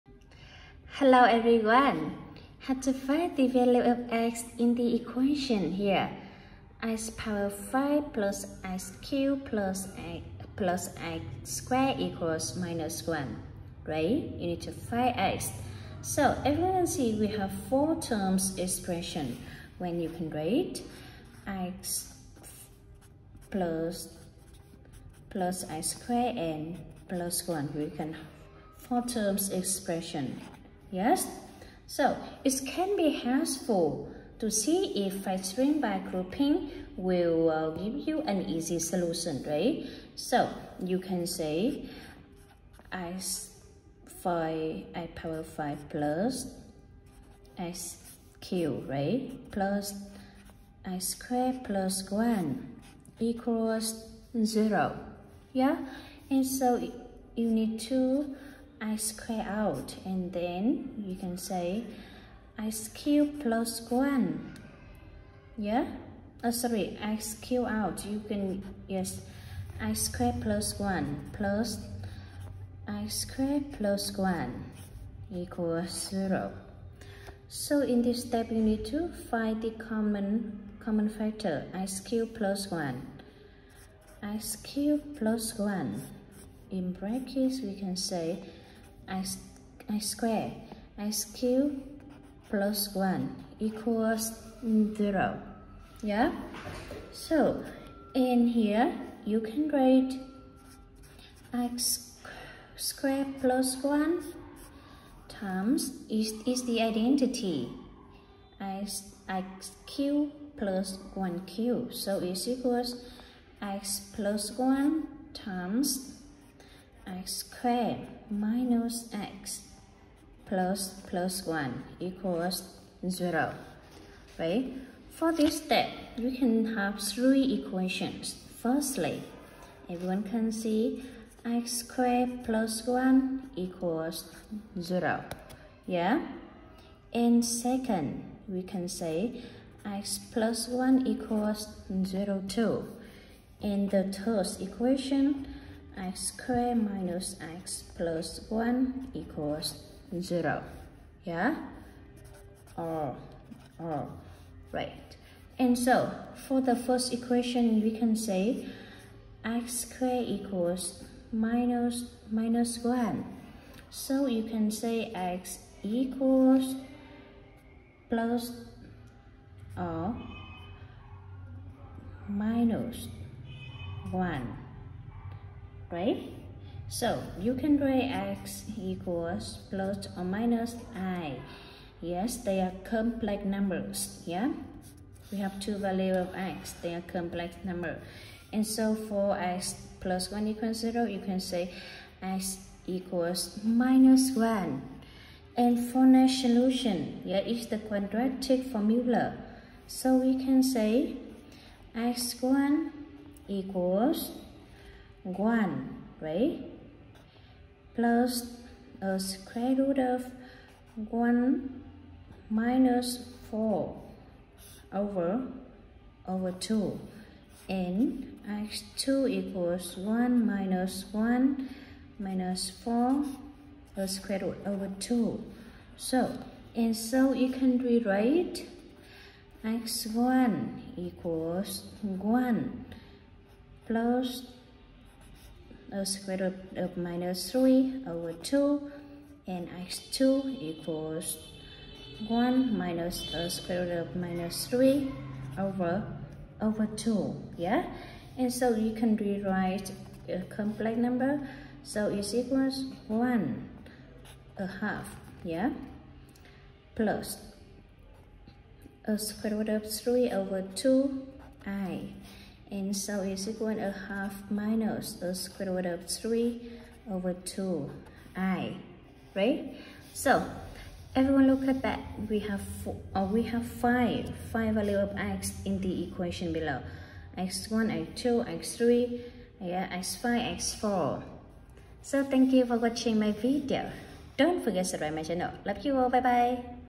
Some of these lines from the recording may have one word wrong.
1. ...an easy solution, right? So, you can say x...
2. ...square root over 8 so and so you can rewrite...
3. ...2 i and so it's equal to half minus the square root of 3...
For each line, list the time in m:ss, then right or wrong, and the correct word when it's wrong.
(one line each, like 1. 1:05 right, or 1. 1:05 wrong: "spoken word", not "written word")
1. 0:38 right
2. 3:44 wrong: "2", not "8"
3. 4:20 right.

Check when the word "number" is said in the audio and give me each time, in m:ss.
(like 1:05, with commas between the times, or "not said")
3:03, 3:07, 4:10.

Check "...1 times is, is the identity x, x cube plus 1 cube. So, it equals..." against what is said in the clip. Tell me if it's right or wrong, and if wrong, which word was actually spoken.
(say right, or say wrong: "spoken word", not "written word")
right.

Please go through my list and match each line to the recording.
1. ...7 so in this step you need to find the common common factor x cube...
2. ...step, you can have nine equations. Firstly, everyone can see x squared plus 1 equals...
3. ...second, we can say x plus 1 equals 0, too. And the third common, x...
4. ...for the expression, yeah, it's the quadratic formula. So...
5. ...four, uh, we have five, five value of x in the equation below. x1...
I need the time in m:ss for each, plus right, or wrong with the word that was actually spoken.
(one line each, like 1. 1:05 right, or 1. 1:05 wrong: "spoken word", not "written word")
1. 1:16 wrong: "0", not "7"
2. 2:05 wrong: "three", not "nine"
3. 2:17 wrong: "equation", not "common"
4. 3:15 wrong: "solution", not "expression"
5. 4:32 right.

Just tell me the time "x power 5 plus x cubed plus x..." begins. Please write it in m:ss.
0:06.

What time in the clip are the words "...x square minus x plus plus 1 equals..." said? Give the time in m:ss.
1:57.